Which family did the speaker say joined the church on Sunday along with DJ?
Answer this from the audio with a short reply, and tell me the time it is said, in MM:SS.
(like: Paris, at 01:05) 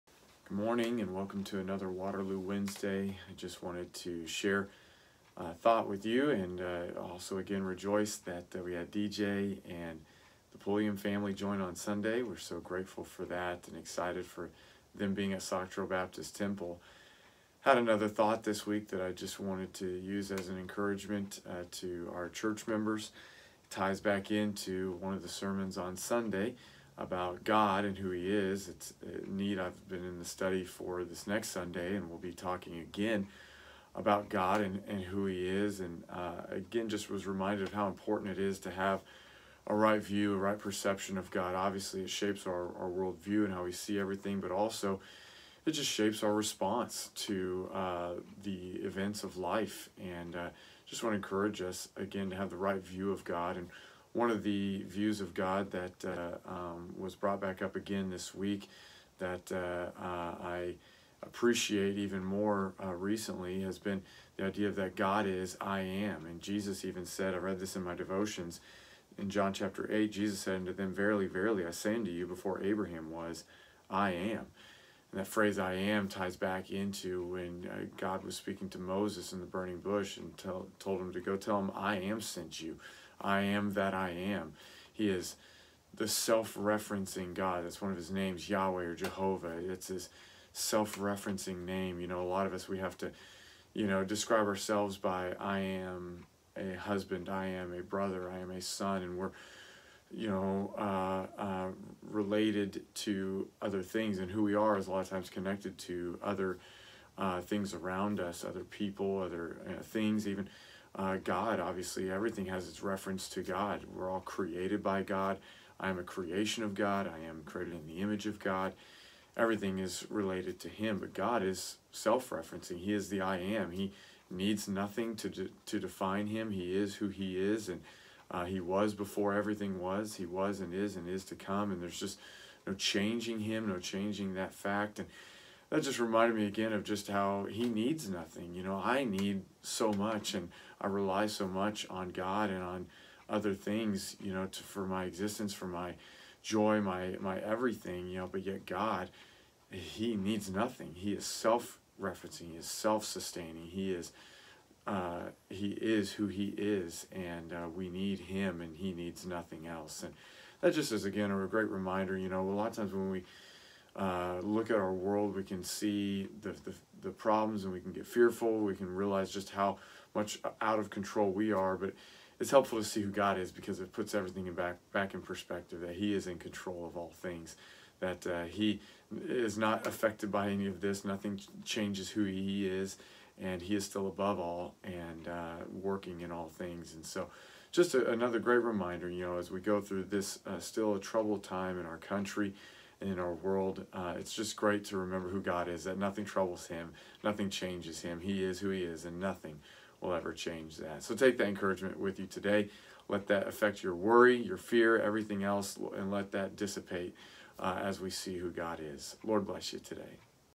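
Pulliam, at 00:10.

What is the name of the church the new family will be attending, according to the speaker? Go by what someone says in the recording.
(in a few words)
Sauk Trail Baptist Temple.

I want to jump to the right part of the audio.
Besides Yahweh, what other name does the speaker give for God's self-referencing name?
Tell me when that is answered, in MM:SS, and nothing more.
01:28.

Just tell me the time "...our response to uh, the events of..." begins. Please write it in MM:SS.
00:46.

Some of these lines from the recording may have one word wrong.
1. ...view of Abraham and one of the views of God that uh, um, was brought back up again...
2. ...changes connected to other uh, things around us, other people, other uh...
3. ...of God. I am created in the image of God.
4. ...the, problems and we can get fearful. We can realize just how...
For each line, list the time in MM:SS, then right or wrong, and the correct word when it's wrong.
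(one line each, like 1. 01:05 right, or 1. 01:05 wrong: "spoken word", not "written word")
1. 00:52 wrong: "God", not "Abraham"
2. 01:45 wrong: "times", not "changes"
3. 01:56 right
4. 02:47 right.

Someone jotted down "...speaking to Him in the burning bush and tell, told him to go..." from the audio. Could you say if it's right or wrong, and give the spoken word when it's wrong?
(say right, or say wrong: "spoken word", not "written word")
wrong: "Moses", not "Him".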